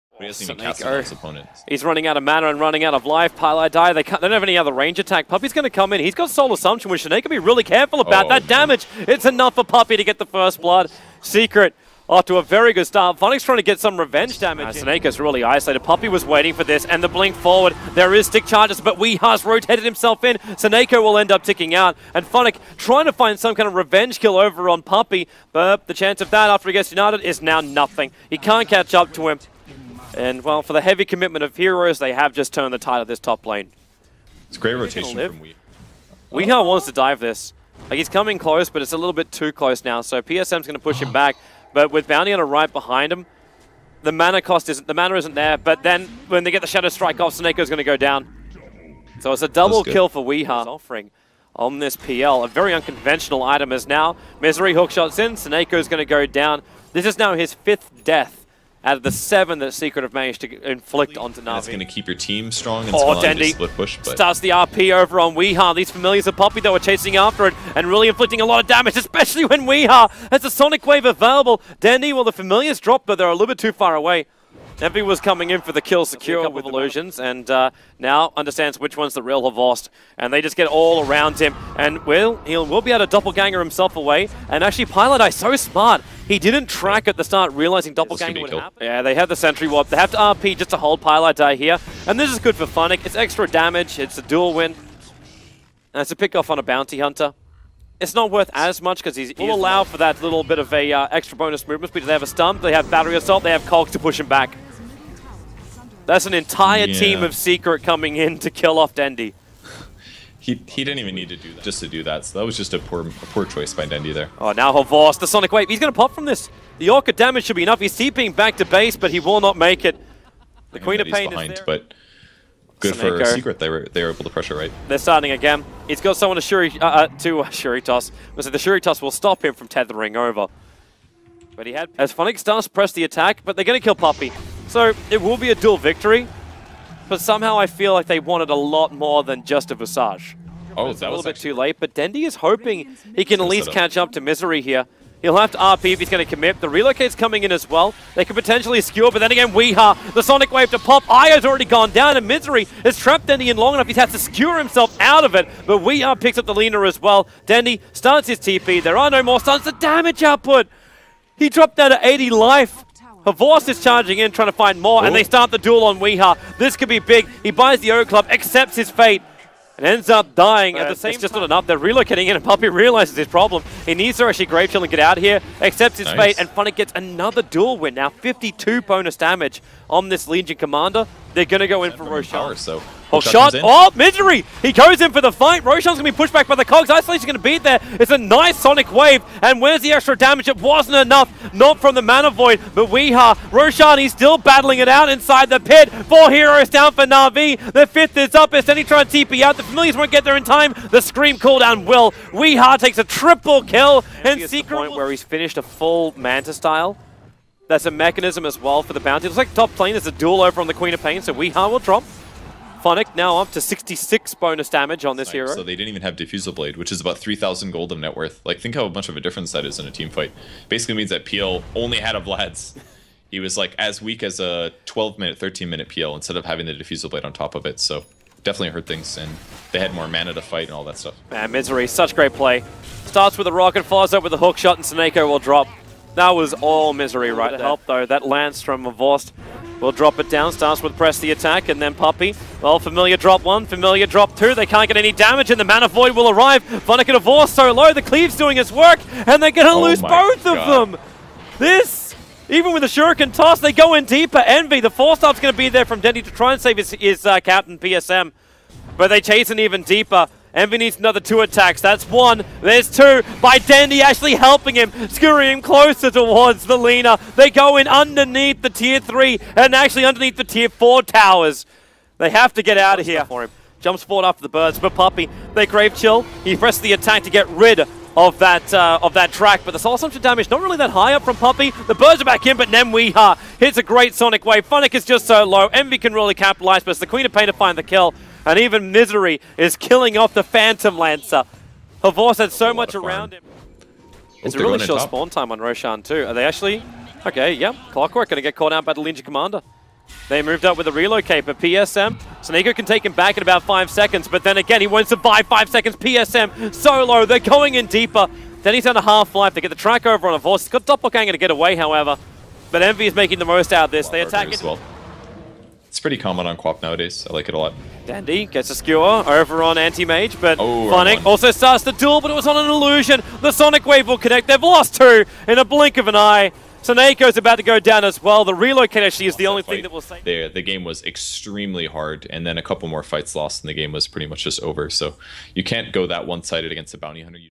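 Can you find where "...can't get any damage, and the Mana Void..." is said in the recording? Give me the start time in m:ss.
4:04.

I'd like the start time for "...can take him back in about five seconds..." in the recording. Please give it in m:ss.
5:02.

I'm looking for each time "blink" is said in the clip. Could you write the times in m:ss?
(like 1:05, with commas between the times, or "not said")
0:17, 5:25.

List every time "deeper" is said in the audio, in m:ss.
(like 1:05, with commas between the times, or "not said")
4:14, 4:19, 5:07.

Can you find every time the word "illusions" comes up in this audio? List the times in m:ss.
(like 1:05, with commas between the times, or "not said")
1:16, 5:22.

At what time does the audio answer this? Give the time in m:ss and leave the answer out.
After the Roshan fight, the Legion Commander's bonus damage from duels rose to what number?
3:33.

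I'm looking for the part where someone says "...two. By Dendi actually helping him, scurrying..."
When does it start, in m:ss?
4:22.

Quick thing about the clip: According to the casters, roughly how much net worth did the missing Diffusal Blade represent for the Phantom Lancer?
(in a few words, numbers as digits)
3,000 gold.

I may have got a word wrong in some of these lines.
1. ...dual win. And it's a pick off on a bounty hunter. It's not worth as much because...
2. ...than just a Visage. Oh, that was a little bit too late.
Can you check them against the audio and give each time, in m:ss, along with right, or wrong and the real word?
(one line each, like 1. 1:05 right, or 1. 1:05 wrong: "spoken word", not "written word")
1. 1:34 right
2. 2:19 right.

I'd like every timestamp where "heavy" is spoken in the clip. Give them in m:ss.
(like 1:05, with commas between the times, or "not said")
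0:30.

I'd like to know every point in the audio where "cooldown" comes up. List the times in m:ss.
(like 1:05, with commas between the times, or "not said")
3:21.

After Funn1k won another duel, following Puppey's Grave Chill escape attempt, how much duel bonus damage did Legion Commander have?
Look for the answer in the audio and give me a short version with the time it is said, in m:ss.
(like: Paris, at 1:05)
52, at 2:58.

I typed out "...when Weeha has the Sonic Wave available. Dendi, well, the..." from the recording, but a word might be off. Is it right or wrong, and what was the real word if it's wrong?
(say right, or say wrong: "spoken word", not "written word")
right.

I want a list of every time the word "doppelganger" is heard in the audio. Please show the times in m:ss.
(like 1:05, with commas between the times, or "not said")
1:23, 1:27, 5:10.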